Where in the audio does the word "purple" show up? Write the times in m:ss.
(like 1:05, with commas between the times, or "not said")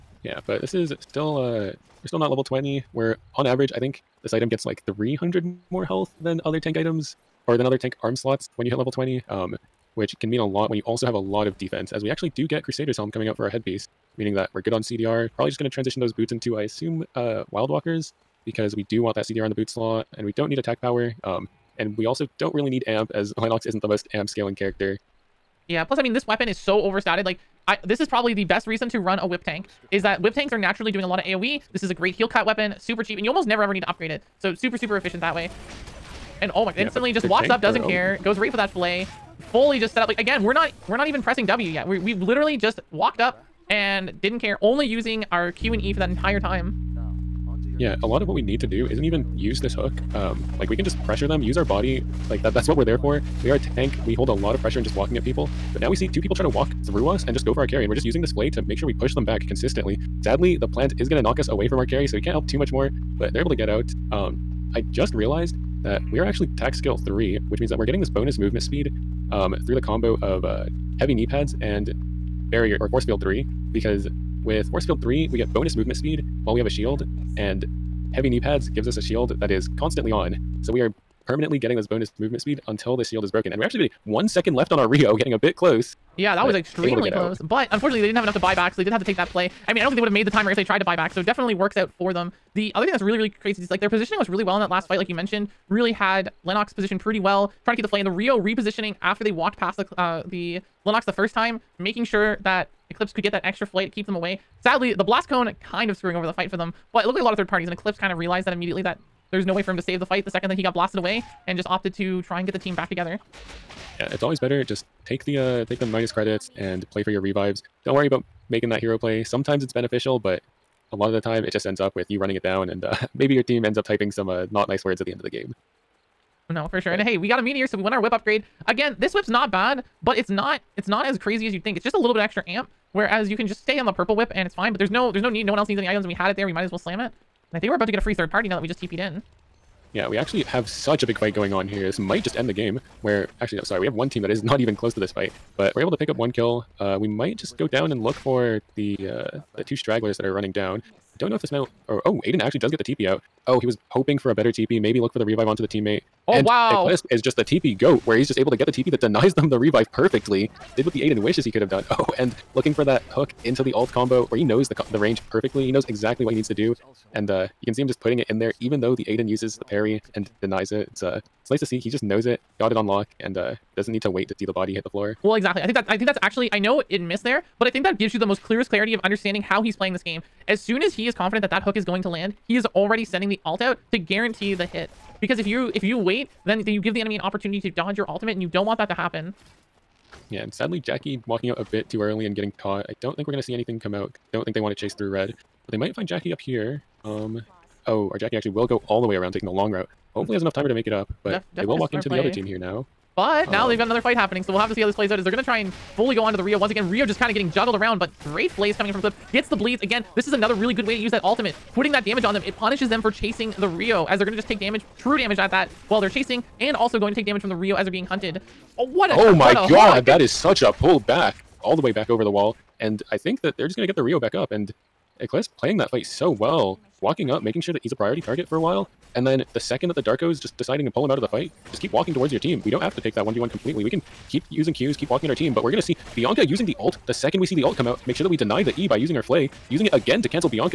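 2:13.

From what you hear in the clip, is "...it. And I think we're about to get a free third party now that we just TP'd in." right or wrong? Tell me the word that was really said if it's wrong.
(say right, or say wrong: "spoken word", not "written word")
right.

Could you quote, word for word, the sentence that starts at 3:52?
We don't have to take that 1v1 completely.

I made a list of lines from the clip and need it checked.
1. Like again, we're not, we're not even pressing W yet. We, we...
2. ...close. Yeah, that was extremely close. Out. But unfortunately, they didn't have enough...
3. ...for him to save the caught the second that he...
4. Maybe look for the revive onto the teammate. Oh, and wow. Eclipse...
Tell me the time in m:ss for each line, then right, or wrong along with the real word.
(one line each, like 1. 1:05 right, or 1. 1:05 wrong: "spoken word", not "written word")
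1. 0:40 right
2. 1:25 right
3. 1:49 wrong: "fight", not "caught"
4. 2:34 right.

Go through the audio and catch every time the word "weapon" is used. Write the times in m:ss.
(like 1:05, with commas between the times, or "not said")
0:26, 0:32.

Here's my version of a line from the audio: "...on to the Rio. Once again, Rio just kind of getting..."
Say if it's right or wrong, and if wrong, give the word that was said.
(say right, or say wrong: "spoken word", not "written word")
right.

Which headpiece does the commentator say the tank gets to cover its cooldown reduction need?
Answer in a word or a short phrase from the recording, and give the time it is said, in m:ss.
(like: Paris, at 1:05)
Crusader's Helm, at 0:12.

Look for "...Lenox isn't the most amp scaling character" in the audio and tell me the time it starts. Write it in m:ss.
0:23.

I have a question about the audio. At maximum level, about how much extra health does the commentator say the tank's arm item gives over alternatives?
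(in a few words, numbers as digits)
300.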